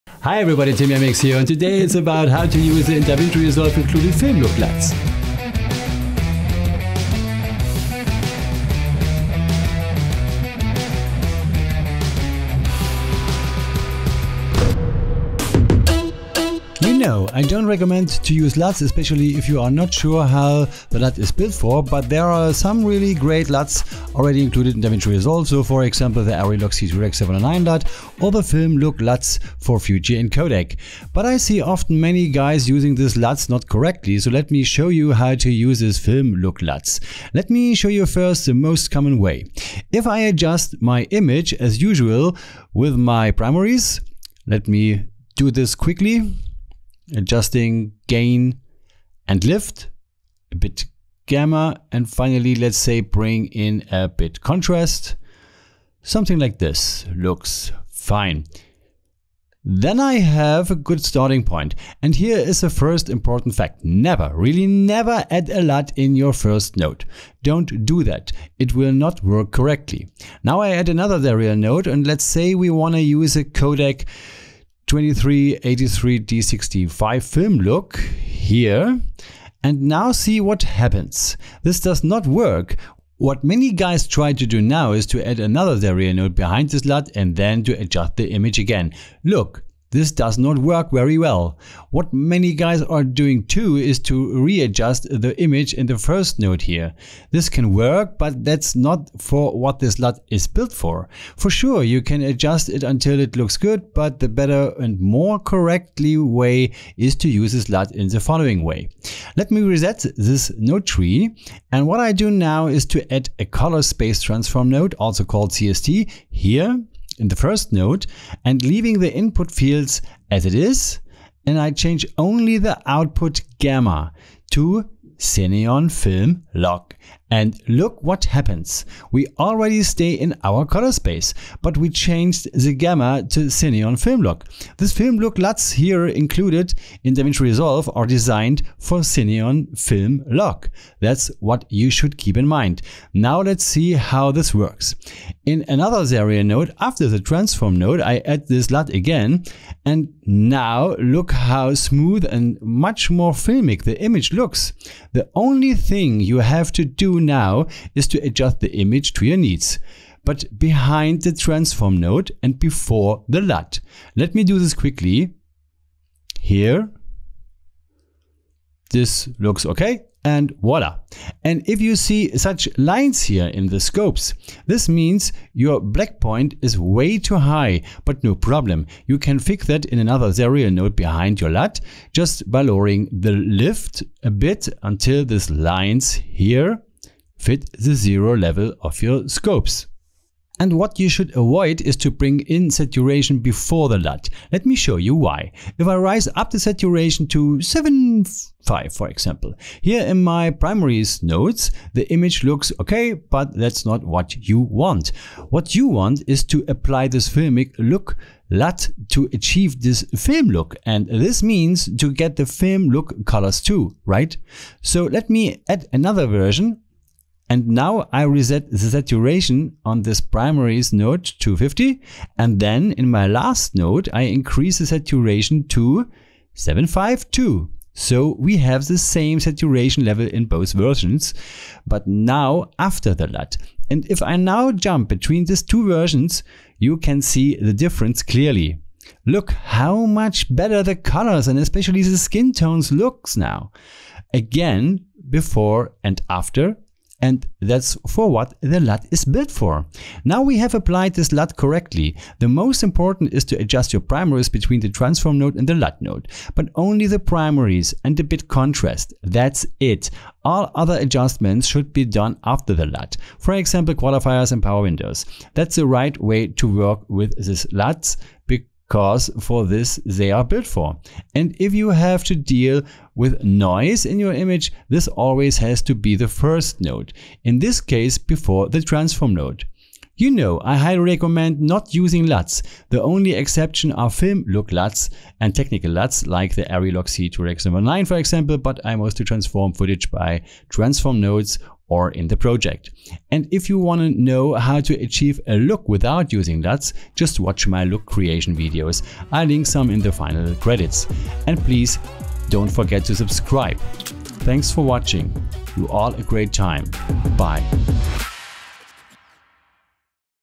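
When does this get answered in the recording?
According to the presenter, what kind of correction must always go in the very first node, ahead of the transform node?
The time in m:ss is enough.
4:33.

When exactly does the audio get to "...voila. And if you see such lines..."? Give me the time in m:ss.
2:50.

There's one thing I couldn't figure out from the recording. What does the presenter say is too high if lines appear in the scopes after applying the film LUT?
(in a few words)
black point.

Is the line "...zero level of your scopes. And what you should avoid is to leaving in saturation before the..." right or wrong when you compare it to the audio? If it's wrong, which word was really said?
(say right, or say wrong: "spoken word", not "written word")
wrong: "bring", not "leaving".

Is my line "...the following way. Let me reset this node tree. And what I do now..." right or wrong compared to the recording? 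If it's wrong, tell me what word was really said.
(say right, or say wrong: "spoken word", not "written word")
right.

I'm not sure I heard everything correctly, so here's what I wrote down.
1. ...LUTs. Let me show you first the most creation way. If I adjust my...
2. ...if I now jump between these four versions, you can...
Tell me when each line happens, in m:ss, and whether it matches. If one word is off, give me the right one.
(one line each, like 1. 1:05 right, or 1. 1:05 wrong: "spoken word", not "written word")
1. 0:36 wrong: "common", not "creation"
2. 3:54 wrong: "two", not "four".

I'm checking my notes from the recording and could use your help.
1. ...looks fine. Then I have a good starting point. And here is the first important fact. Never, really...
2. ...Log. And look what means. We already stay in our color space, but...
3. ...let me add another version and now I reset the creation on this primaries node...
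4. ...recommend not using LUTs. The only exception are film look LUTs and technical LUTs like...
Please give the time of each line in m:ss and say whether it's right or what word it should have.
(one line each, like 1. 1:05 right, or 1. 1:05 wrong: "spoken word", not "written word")
1. 0:57 right
2. 2:06 wrong: "happens", not "means"
3. 3:35 wrong: "saturation", not "creation"
4. 4:40 right.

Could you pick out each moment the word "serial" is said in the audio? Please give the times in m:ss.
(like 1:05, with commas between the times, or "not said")
1:11, 1:25, 2:26, 3:00.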